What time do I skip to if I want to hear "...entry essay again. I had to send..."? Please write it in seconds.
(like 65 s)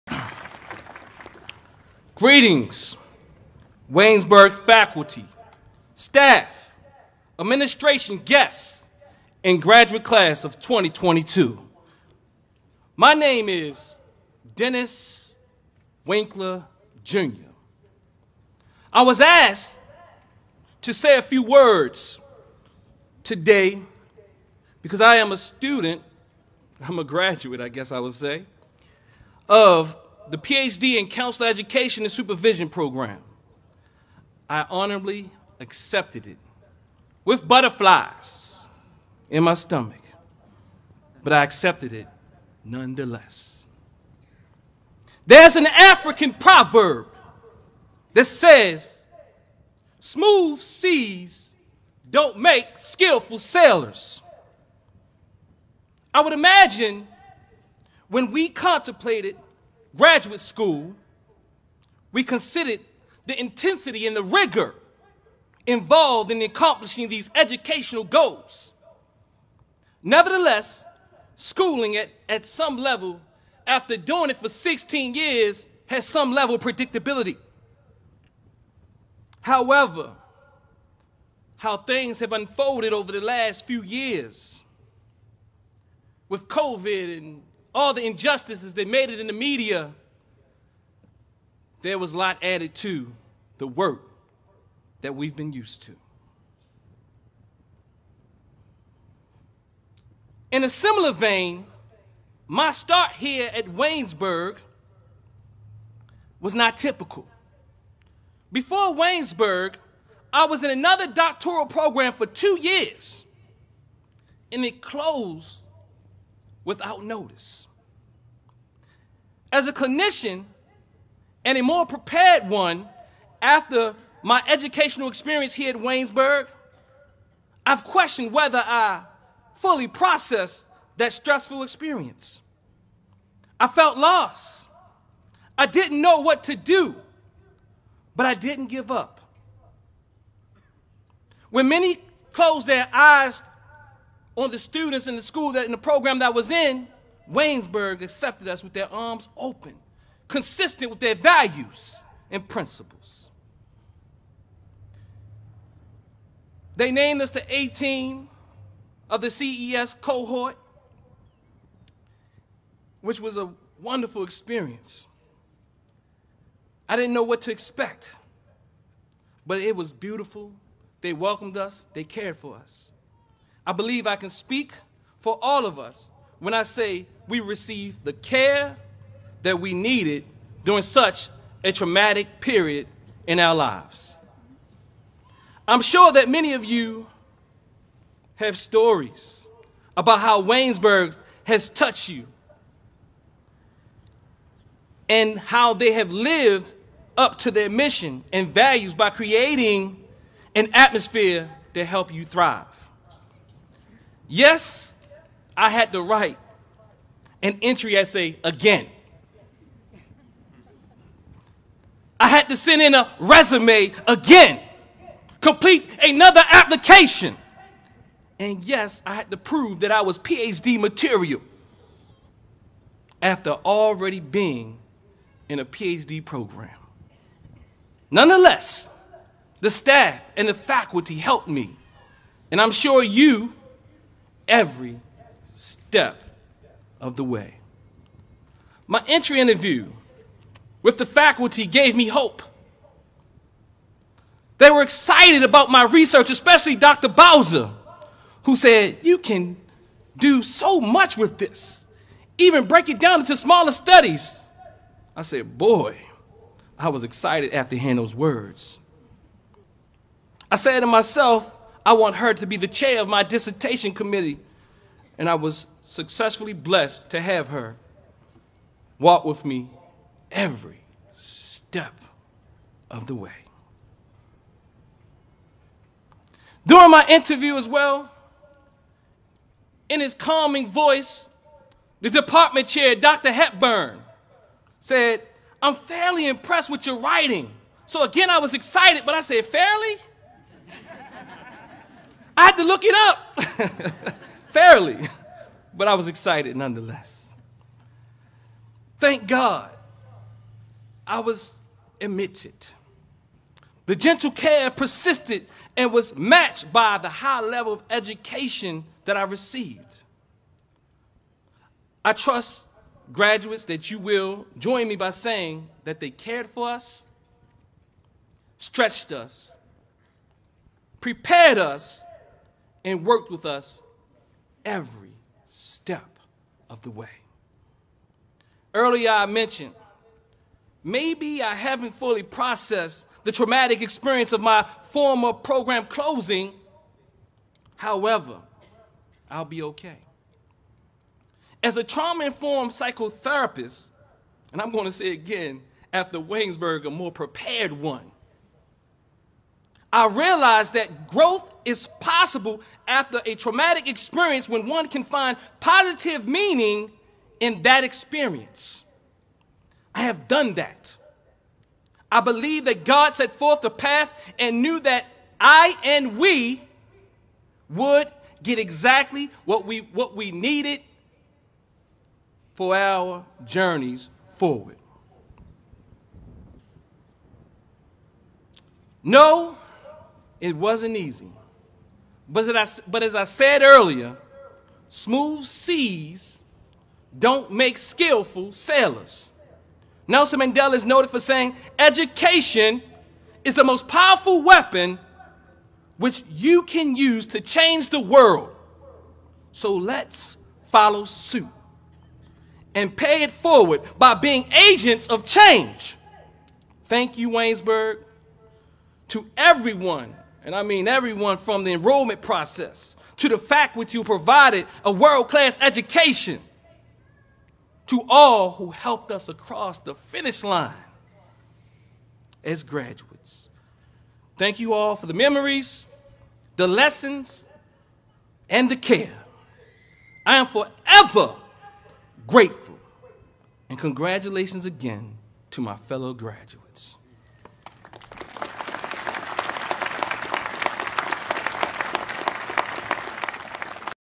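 207 s.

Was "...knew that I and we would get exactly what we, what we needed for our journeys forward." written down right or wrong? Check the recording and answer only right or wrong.
right.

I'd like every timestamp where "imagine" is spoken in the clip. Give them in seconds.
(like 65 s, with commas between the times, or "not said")
56 s.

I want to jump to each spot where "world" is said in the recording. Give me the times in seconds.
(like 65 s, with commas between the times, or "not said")
397 s, 414 s.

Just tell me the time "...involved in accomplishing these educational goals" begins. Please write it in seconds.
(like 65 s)
65 s.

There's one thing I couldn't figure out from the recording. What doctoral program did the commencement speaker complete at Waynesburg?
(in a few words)
Counselor Education and Supervision.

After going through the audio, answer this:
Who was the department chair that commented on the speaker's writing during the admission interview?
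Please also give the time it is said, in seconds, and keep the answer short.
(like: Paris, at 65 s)
Dr. Hepburn, at 282 s.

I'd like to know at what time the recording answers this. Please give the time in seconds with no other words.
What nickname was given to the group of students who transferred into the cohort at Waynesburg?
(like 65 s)
157 s.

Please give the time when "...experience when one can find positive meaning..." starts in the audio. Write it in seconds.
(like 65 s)
353 s.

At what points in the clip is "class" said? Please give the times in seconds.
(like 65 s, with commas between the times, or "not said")
10 s, 415 s.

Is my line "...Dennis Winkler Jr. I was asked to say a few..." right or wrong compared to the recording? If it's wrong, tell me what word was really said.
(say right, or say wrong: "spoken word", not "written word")
right.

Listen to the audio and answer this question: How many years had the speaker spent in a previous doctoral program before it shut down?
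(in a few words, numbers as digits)
2.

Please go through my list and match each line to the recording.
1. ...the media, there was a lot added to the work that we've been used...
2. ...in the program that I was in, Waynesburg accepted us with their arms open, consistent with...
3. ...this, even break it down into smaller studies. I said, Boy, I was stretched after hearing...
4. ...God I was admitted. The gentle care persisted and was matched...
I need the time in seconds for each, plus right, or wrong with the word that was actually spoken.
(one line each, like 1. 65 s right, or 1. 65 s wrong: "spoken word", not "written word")
1. 89 s right
2. 145 s right
3. 251 s wrong: "excited", not "stretched"
4. 299 s right.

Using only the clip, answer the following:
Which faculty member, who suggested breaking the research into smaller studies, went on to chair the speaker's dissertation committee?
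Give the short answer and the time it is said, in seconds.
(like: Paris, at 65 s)
Dr. Bowser, at 246 s.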